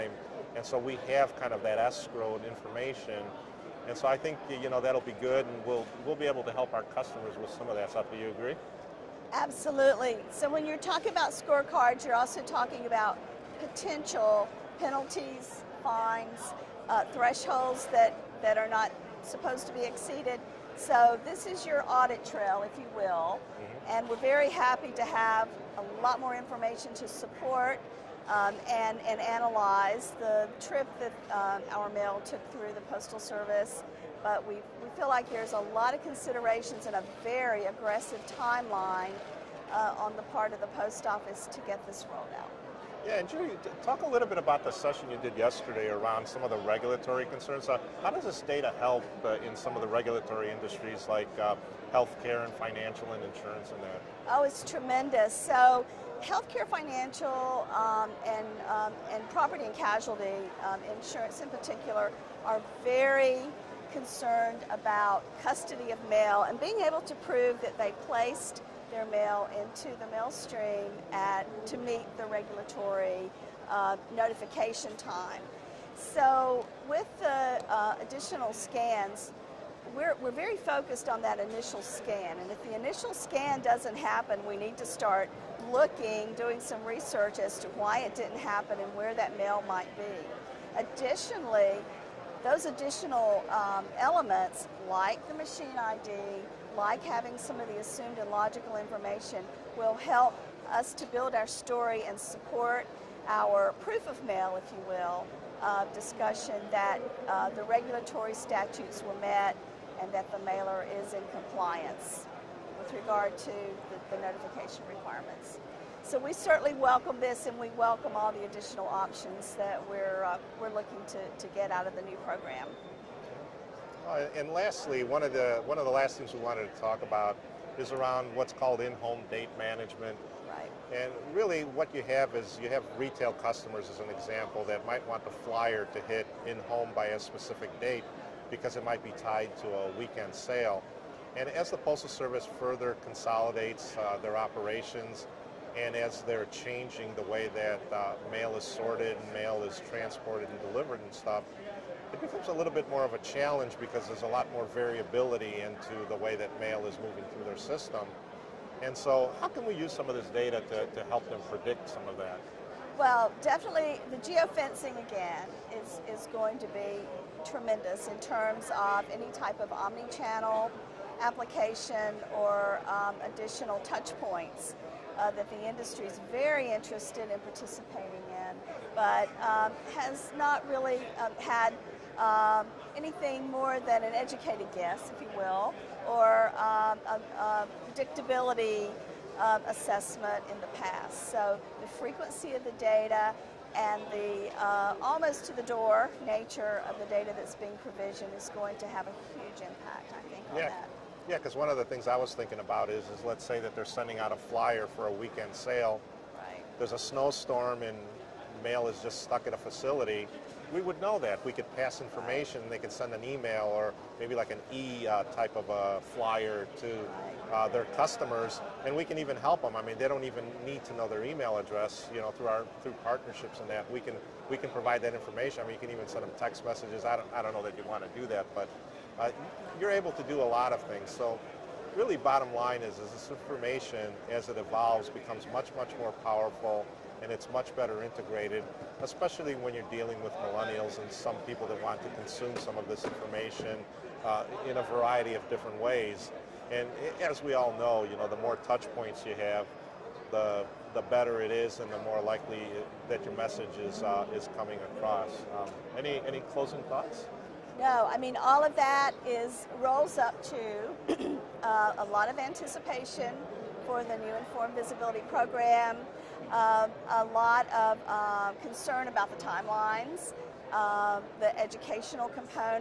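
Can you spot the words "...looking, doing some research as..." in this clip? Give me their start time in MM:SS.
01:25.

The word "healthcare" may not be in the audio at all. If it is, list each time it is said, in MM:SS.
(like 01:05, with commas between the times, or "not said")
00:51, 00:56.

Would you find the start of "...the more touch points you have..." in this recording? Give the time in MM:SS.
04:08.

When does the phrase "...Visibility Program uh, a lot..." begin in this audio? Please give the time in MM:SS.
04:24.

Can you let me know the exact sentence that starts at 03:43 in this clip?
We can we can provide that information.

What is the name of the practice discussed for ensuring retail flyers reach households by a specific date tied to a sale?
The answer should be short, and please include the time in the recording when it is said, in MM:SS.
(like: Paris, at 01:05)
in-home date management, at 02:08.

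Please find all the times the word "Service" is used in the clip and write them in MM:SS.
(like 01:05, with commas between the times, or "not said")
00:33, 02:22.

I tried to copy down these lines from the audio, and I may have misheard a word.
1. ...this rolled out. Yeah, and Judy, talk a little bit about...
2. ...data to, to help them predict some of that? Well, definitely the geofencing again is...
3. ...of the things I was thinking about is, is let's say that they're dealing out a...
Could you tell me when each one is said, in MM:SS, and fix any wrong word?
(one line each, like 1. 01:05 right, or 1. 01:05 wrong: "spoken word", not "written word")
1. 00:41 right
2. 02:40 right
3. 03:21 wrong: "sending", not "dealing".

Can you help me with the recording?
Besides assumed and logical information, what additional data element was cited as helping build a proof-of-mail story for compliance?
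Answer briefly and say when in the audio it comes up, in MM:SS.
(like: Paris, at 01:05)
machine ID, at 01:35.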